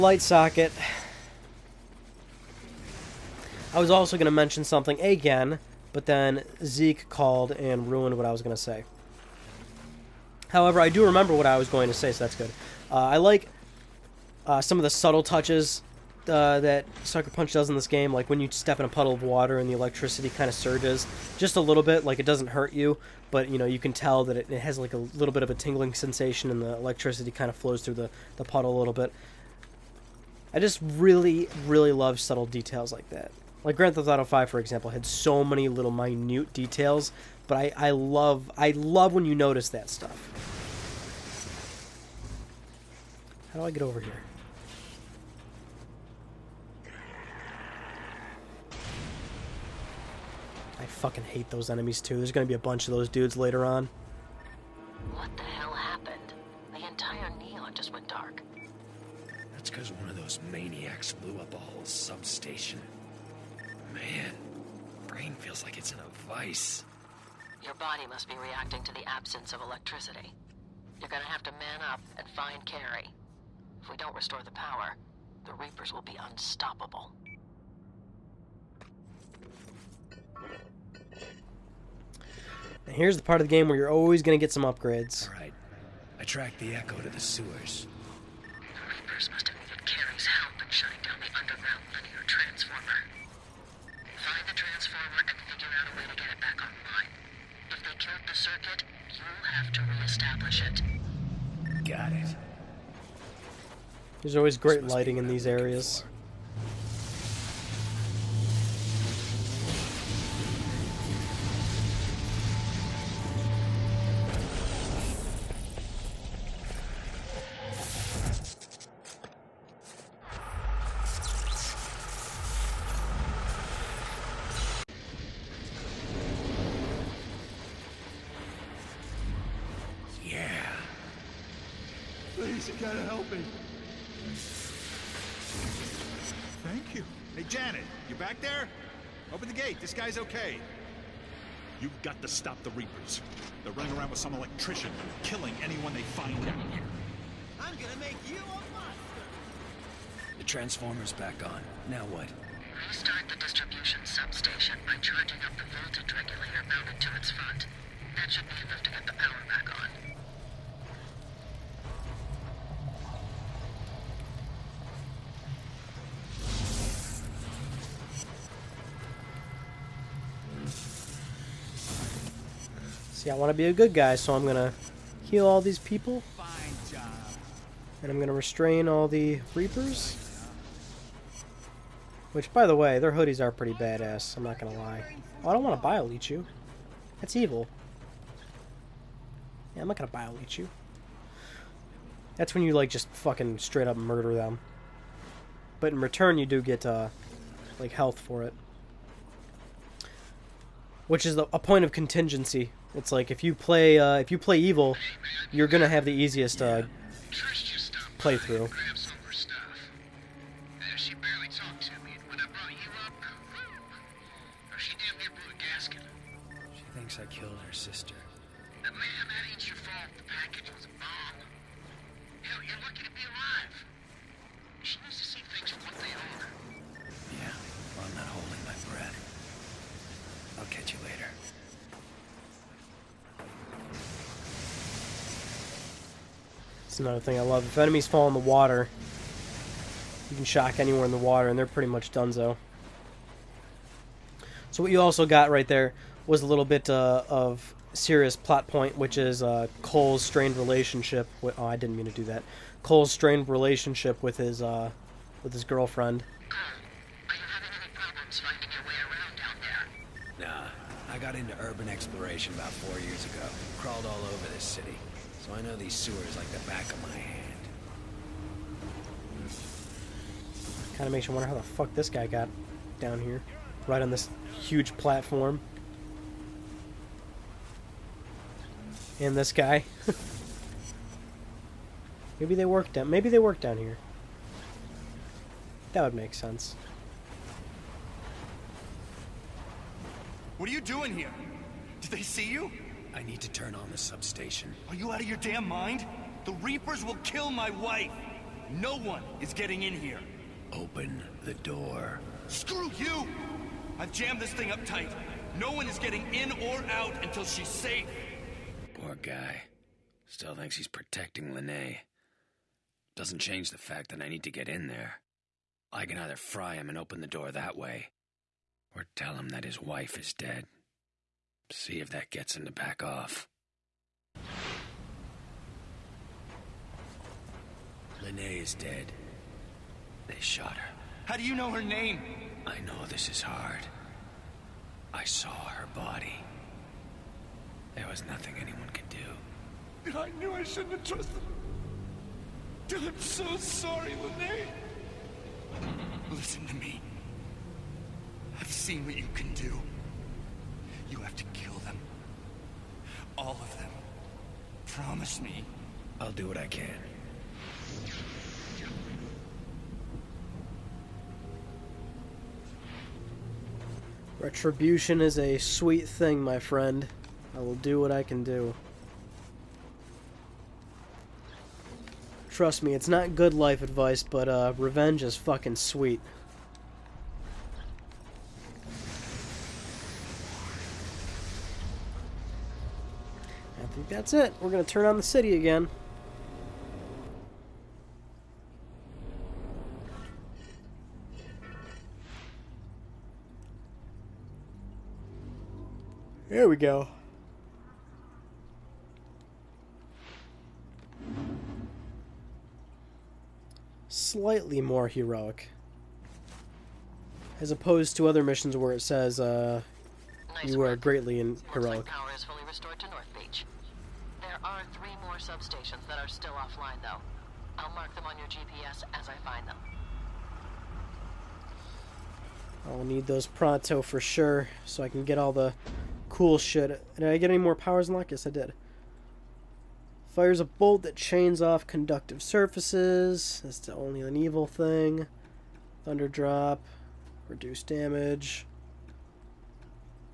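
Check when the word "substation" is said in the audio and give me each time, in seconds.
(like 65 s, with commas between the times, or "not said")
61 s, 154 s, 293 s.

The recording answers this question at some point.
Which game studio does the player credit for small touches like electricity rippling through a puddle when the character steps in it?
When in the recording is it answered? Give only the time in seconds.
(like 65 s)
17 s.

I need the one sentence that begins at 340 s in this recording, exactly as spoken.
I knew I shouldn't have trusted her.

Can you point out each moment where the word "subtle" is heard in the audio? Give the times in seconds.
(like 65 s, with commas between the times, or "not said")
14 s, 32 s.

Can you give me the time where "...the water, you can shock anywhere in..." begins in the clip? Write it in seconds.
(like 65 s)
238 s.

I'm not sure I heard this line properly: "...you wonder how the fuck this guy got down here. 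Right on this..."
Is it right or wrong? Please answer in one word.
right.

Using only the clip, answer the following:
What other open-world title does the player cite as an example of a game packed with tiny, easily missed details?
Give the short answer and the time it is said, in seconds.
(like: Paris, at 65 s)
Grand Theft Auto 5, at 33 s.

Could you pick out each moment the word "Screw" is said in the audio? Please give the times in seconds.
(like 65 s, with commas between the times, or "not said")
302 s.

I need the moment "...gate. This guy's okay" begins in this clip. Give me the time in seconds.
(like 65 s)
139 s.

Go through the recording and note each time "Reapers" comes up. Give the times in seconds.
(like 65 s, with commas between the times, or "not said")
75 s, 88 s, 142 s, 179 s, 296 s.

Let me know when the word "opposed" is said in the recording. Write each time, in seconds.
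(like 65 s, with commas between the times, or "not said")
407 s.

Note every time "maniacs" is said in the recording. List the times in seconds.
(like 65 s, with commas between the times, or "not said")
60 s.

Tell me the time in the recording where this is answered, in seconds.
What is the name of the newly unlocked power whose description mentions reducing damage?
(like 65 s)
436 s.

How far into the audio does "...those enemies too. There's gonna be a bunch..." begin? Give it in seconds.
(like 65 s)
51 s.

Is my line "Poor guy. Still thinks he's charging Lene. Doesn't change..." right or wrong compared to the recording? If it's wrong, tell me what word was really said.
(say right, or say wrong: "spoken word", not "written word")
wrong: "protecting", not "charging".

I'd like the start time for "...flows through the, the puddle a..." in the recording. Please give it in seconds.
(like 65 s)
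27 s.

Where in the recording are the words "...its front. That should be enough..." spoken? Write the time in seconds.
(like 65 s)
157 s.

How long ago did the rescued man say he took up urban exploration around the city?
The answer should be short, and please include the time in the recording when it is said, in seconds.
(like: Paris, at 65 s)
4 years, at 262 s.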